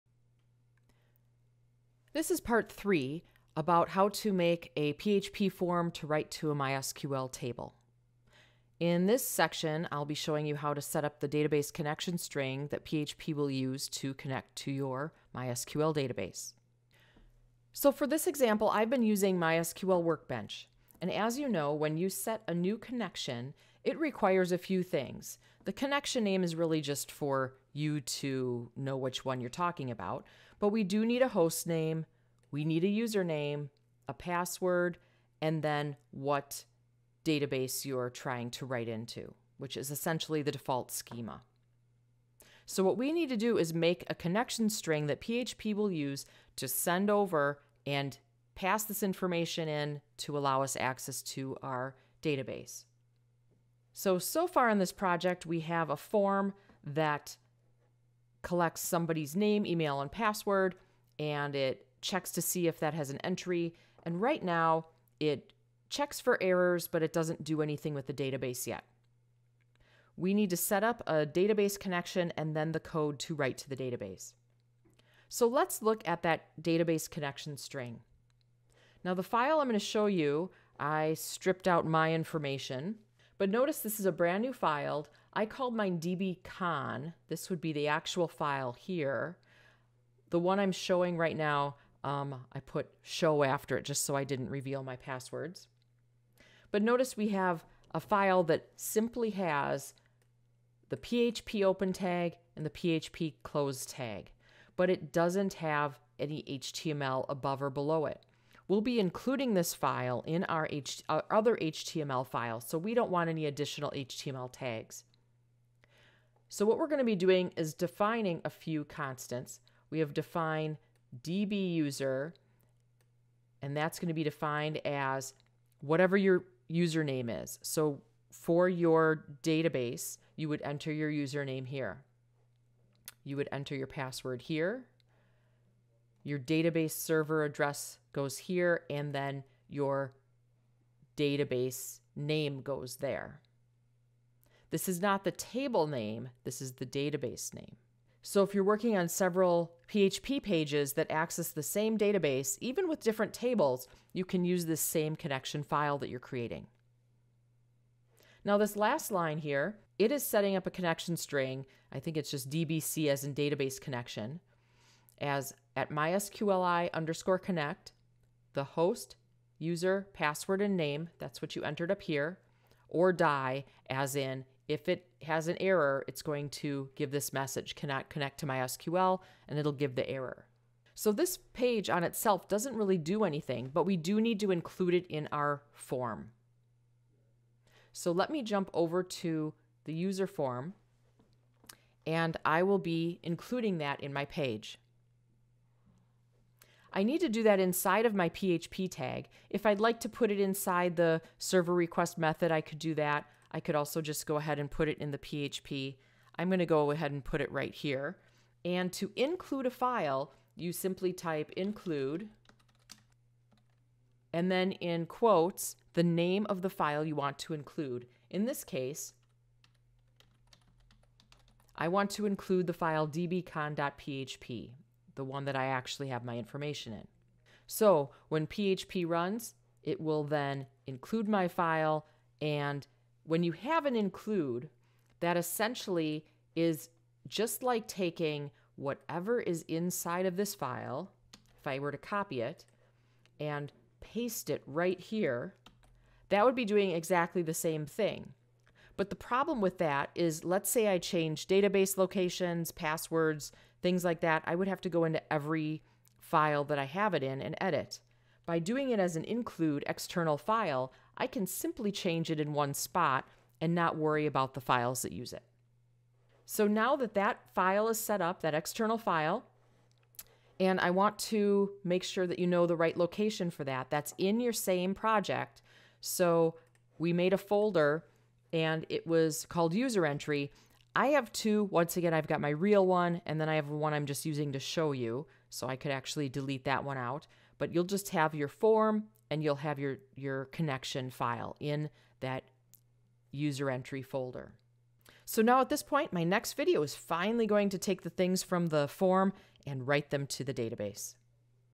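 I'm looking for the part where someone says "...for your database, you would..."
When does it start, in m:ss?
2:08.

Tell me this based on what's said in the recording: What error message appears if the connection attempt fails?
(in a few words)
cannot connect to MySQL.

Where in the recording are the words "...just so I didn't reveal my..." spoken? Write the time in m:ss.
1:33.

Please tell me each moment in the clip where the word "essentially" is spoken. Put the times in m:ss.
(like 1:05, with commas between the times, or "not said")
0:39, 3:55.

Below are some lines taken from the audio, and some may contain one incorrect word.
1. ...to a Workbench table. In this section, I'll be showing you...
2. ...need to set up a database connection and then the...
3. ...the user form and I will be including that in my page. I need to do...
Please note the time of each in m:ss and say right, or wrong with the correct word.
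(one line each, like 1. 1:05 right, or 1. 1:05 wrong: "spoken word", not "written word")
1. 0:06 wrong: "MySQL", not "Workbench"
2. 1:10 right
3. 3:09 right.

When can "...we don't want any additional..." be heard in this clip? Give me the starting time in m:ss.
1:52.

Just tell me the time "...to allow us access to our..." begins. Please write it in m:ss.
0:50.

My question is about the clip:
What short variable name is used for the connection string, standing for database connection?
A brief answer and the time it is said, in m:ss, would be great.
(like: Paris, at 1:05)
DBC, at 2:42.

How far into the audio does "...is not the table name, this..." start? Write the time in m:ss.
2:24.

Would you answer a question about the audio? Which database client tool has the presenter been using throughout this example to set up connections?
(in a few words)
MySQL Workbench.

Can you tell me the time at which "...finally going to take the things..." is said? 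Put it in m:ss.
4:56.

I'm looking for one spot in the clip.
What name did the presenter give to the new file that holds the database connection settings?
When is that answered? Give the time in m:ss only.
1:25.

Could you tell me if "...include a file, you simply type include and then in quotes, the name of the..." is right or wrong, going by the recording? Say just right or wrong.
right.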